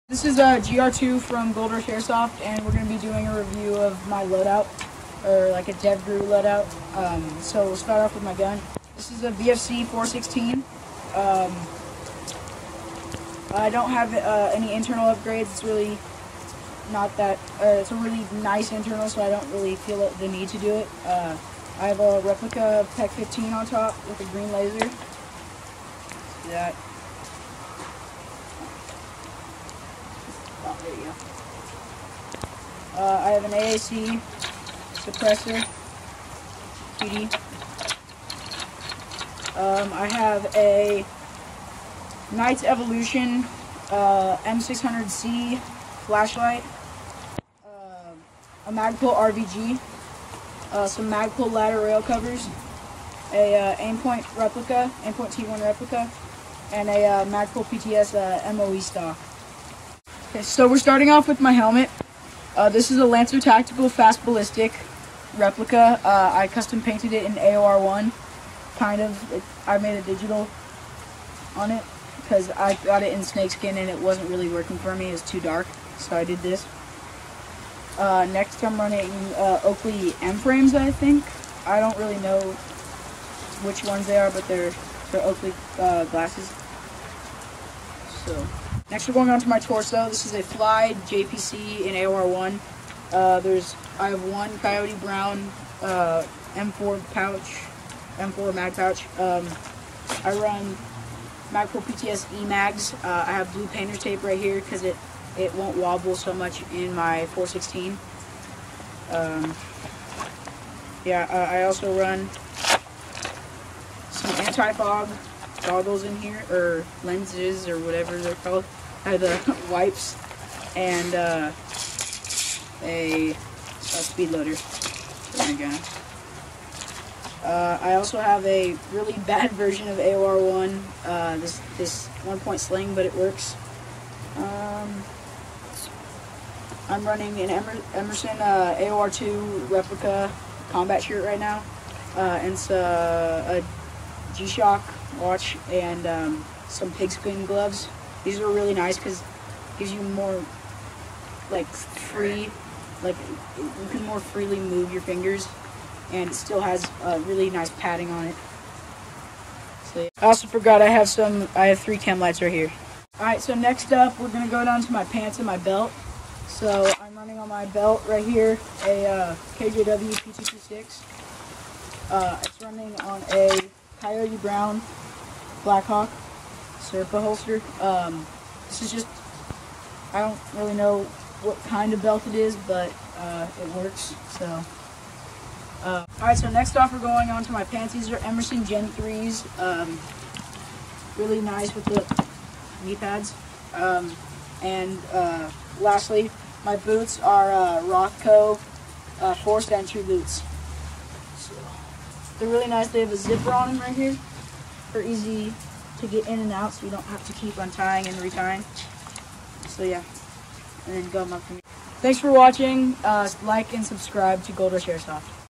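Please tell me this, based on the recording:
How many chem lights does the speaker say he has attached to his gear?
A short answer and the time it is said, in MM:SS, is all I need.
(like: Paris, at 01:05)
3, at 02:41.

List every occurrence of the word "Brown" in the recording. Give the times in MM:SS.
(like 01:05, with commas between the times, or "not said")
01:35, 02:54.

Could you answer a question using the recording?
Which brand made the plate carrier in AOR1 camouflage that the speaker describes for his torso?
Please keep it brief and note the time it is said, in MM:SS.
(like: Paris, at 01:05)
FLYYE, at 01:30.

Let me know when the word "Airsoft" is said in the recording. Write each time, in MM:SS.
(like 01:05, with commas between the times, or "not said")
00:01, 03:34.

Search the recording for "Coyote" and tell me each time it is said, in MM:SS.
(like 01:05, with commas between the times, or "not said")
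01:34, 02:54.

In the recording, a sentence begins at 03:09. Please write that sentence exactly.
Um, really nice with the knee pads.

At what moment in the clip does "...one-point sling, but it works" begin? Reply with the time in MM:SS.
02:12.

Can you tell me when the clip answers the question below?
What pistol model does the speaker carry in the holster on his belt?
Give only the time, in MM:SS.
02:50.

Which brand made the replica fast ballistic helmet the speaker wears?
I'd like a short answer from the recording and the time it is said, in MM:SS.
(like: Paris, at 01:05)
Lancer Tactical, at 01:03.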